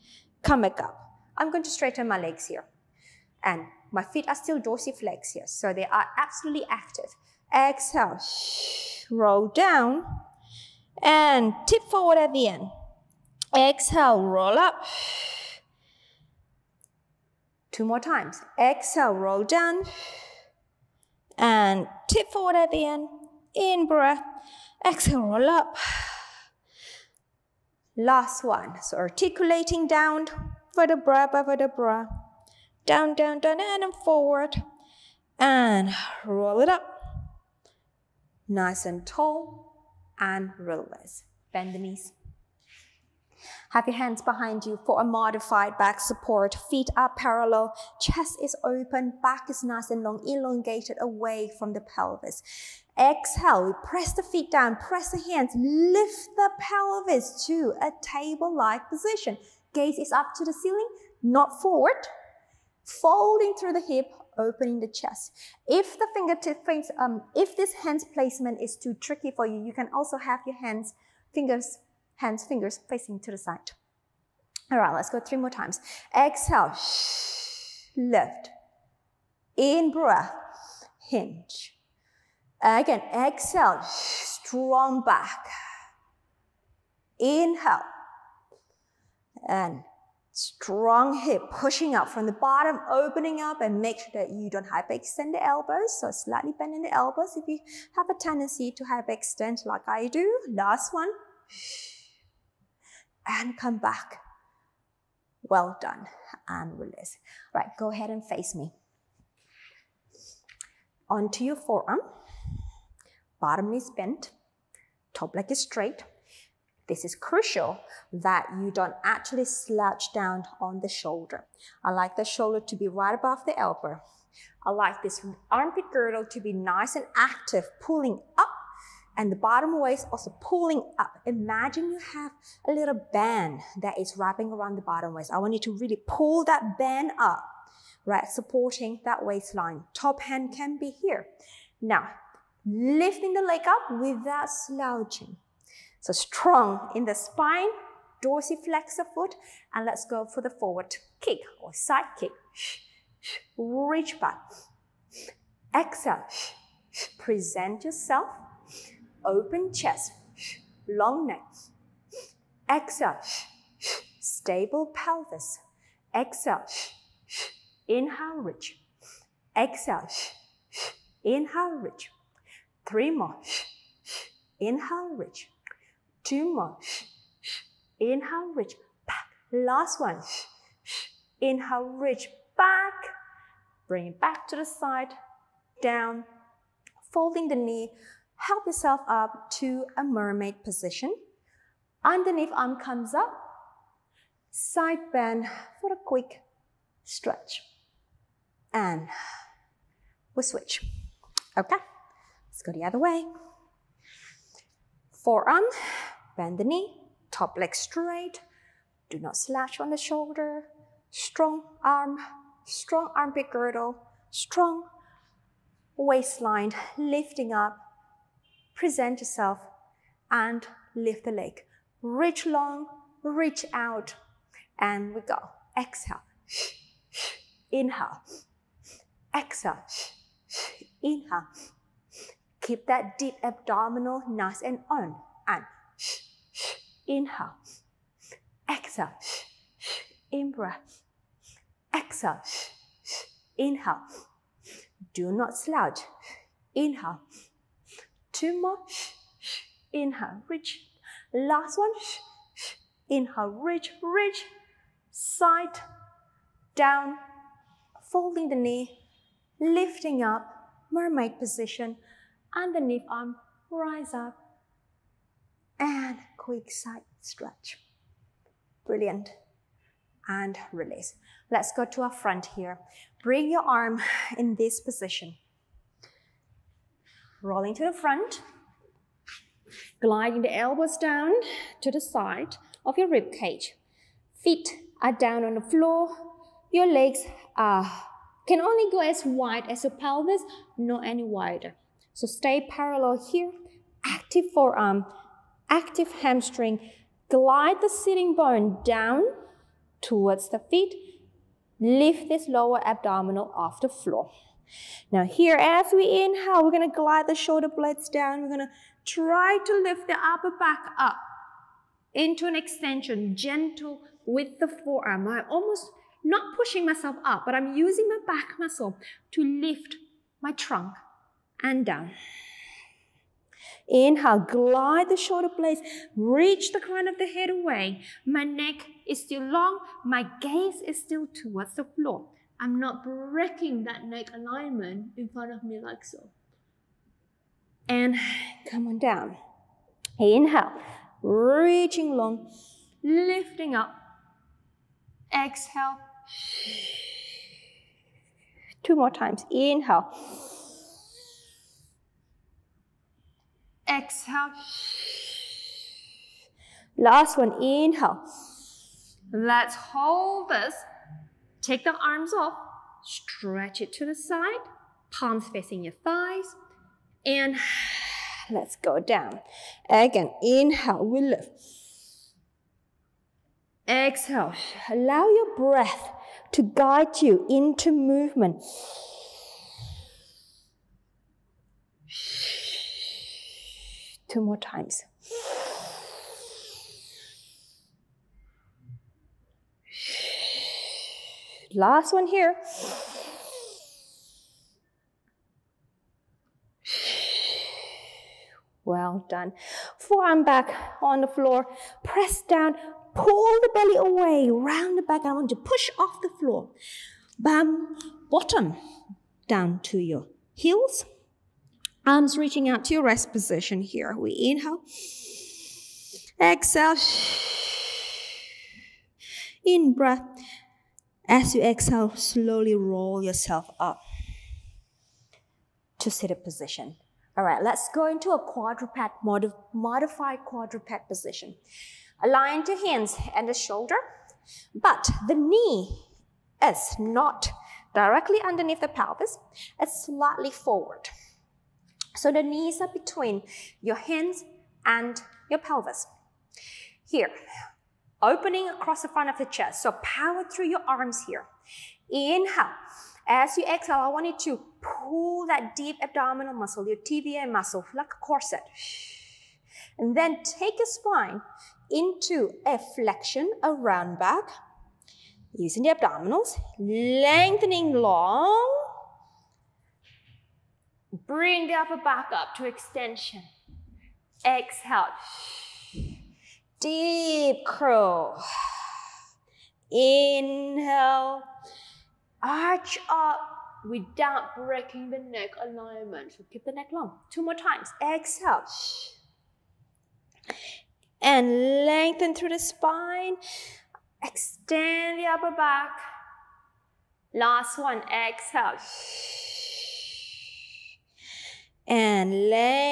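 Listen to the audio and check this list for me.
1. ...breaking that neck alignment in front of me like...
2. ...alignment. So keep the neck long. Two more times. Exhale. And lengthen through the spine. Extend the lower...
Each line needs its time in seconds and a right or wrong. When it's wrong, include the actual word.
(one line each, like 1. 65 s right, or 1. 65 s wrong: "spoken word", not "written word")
1. 333 s right
2. 485 s wrong: "upper", not "lower".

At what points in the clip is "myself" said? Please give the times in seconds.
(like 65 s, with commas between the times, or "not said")
316 s.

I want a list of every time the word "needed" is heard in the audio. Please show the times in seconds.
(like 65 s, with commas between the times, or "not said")
not said.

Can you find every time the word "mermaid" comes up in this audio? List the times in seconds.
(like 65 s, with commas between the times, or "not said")
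190 s, 260 s.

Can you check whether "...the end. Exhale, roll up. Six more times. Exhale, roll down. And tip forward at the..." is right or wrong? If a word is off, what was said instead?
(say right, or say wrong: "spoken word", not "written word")
wrong: "Two", not "Six".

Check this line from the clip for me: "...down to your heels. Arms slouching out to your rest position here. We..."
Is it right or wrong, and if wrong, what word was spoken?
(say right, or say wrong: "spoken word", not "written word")
wrong: "reaching", not "slouching".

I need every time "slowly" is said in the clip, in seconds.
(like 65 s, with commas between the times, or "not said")
422 s.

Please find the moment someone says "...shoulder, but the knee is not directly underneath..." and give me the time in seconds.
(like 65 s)
433 s.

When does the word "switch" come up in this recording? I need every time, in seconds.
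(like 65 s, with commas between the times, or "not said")
200 s.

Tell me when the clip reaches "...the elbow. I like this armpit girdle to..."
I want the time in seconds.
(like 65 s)
123 s.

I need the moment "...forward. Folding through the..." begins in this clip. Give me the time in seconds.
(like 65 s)
61 s.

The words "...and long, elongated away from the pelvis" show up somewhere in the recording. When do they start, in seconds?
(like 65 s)
49 s.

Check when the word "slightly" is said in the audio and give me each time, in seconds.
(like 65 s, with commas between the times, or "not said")
96 s, 440 s.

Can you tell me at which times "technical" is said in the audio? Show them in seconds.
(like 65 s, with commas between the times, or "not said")
not said.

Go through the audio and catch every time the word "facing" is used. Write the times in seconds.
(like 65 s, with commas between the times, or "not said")
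72 s, 365 s.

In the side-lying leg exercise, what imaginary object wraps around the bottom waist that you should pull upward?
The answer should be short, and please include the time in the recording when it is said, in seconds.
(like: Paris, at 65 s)
a little band, at 132 s.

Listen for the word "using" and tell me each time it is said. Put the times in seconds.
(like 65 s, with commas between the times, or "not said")
317 s, 465 s.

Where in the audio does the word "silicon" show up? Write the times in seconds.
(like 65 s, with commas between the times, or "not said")
not said.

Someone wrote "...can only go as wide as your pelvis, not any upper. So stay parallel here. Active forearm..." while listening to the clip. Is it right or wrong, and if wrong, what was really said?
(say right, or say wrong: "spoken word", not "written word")
wrong: "wider", not "upper".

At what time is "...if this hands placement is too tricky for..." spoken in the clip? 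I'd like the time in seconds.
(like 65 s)
67 s.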